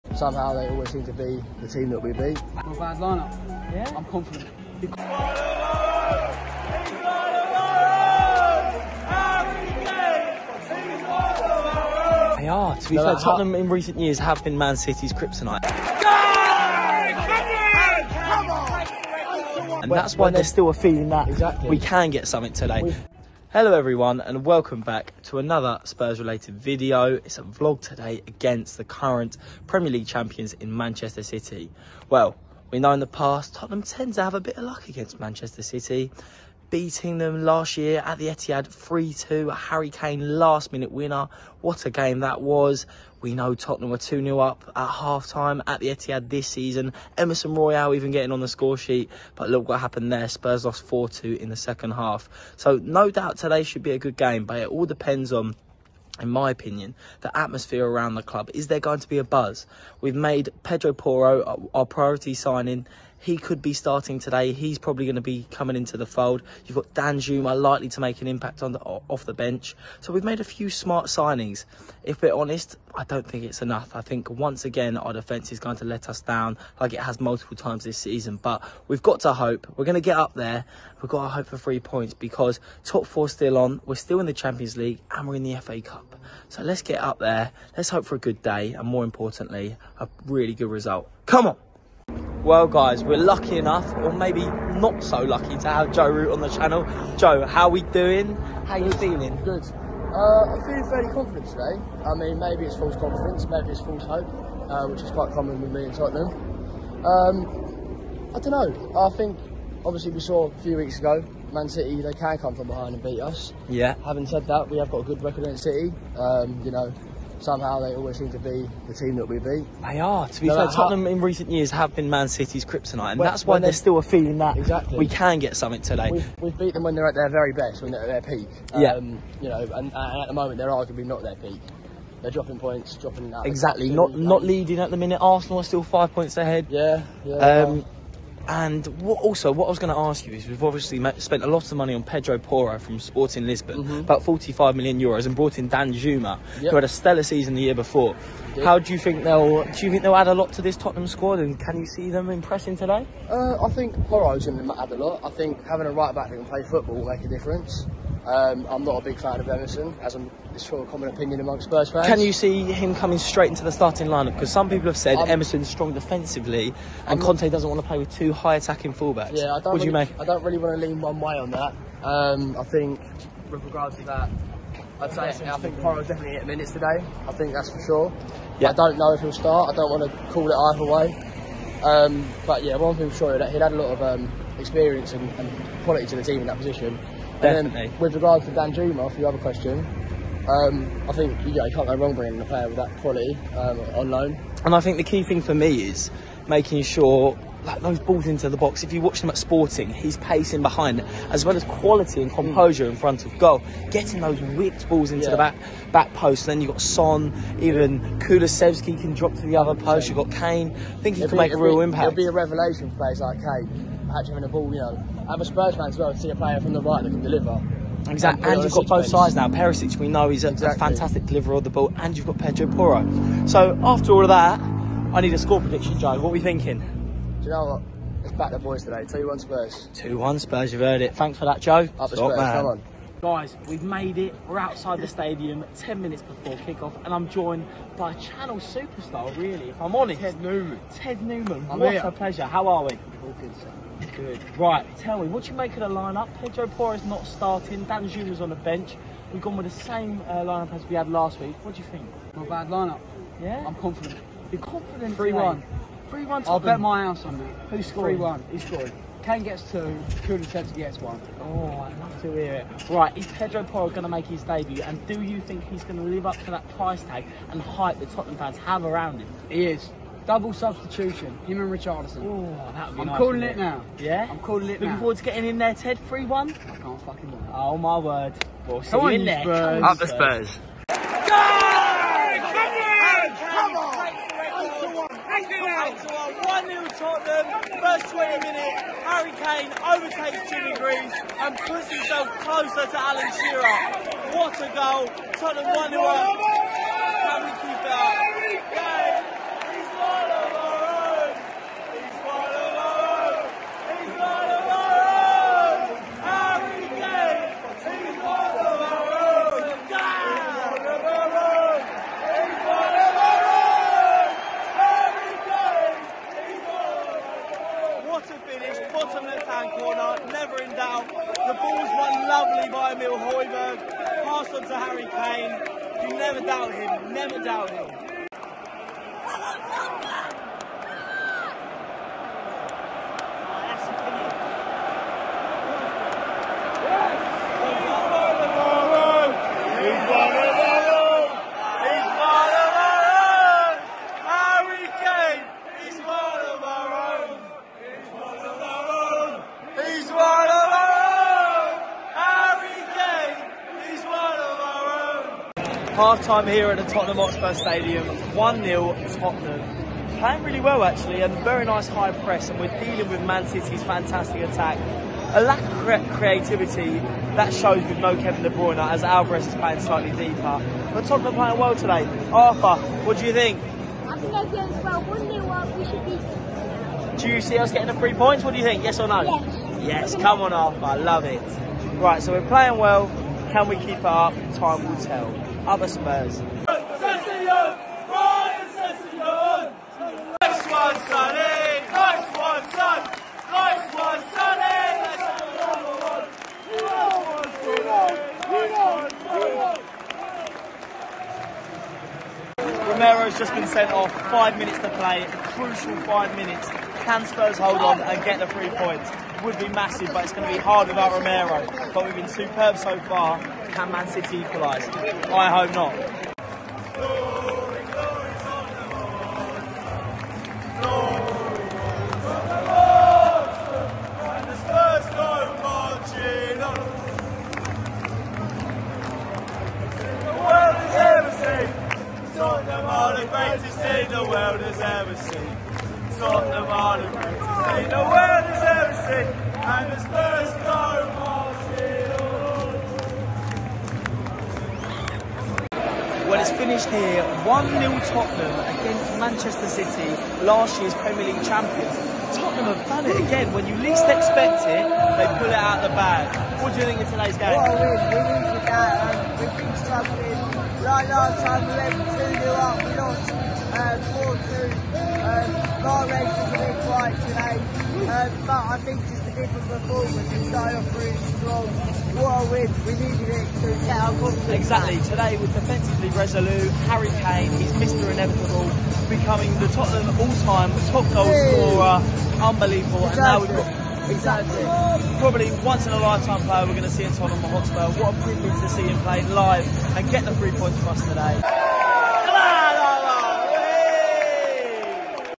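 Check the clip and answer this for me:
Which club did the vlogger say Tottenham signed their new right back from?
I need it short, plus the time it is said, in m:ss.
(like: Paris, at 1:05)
Sporting Lisbon, at 2:22.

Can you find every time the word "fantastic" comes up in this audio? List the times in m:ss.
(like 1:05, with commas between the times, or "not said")
3:40, 6:03.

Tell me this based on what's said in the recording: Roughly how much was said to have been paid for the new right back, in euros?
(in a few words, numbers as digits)
45 million euros.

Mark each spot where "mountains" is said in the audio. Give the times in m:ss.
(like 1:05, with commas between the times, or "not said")
not said.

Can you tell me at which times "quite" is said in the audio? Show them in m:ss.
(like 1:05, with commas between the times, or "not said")
1:45.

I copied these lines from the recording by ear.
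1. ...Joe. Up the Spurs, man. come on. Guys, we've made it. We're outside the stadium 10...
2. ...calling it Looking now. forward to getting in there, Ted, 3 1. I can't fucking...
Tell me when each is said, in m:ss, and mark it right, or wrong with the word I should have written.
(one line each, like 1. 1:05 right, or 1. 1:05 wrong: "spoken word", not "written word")
1. 3:51 right
2. 4:34 right.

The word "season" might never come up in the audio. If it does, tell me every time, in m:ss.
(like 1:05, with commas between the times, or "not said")
0:46, 1:17, 2:27.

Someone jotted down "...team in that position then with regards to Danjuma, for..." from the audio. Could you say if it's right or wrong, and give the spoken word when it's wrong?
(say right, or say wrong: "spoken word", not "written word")
right.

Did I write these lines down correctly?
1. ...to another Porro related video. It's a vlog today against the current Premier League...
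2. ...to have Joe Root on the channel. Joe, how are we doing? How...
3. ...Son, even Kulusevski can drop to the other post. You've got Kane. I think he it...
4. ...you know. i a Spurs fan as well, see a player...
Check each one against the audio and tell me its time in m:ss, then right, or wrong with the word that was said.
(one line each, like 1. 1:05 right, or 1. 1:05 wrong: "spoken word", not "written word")
1. 0:25 wrong: "Spurs", not "Porro"
2. 1:35 right
3. 3:26 right
4. 3:34 right.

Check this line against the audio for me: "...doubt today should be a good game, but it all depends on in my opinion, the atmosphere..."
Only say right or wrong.
right.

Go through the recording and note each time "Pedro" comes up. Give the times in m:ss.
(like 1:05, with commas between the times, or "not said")
1:00, 2:22, 3:42, 4:06, 4:23.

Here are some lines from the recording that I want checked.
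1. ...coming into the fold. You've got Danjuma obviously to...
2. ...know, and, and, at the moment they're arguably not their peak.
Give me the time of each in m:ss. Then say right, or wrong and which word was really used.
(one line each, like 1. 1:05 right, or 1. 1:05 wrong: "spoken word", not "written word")
1. 1:05 wrong: "likely", not "obviously"
2. 2:09 right.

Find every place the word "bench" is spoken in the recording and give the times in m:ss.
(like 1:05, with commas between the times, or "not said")
1:09, 4:08.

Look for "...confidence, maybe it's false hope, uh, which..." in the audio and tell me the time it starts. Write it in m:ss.
1:42.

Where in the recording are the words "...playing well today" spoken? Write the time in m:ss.
6:11.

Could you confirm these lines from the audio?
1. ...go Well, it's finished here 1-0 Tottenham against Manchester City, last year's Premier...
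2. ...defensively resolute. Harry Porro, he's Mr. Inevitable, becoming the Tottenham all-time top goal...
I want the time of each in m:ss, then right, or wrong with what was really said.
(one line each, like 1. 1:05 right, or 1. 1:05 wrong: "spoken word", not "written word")
1. 7:20 right
2. 7:55 wrong: "Kane", not "Porro".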